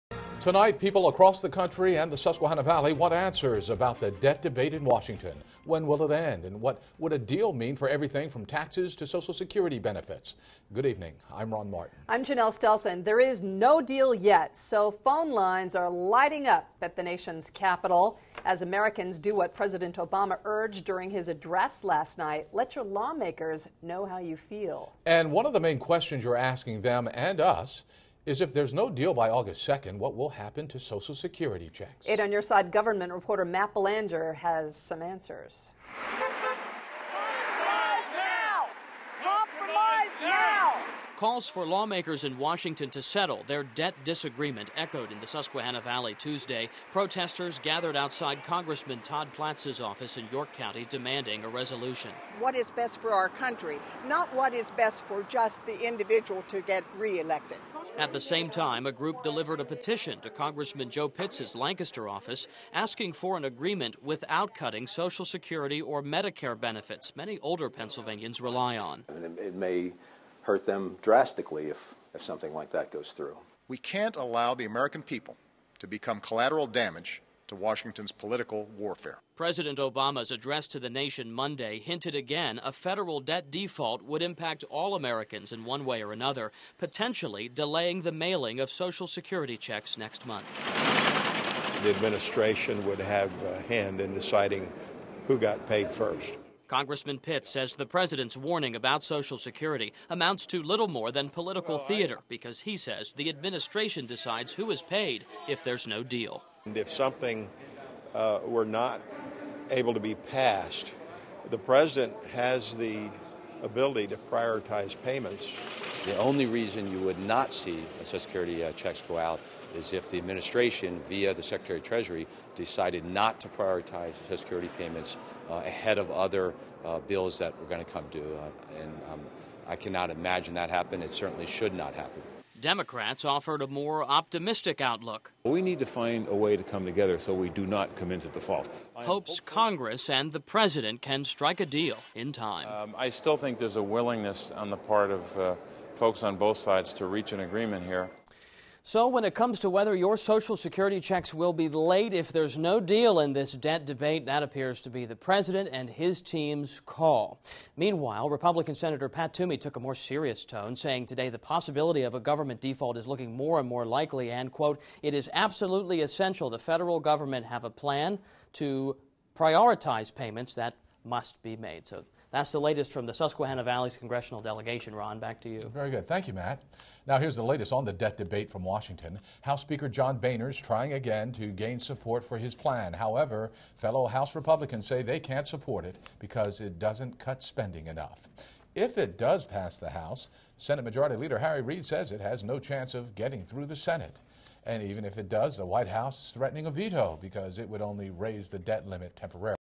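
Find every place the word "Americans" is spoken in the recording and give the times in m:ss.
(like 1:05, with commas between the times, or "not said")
0:18, 1:14, 1:24.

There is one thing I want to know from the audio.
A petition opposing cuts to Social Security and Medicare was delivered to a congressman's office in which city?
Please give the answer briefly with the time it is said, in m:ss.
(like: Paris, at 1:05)
Lancaster, at 1:01.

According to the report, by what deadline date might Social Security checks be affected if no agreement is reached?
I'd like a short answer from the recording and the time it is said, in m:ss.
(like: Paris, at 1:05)
August 2nd, at 0:29.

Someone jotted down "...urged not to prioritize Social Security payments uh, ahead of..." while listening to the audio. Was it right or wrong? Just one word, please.
wrong.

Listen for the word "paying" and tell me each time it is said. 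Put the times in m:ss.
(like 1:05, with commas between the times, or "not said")
not said.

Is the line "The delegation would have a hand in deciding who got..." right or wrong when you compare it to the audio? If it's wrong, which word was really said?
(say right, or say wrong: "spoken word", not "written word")
wrong: "administration", not "delegation".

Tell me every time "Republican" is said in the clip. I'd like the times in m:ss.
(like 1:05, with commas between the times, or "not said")
2:38, 3:04.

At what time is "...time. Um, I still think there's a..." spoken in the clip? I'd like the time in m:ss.
2:22.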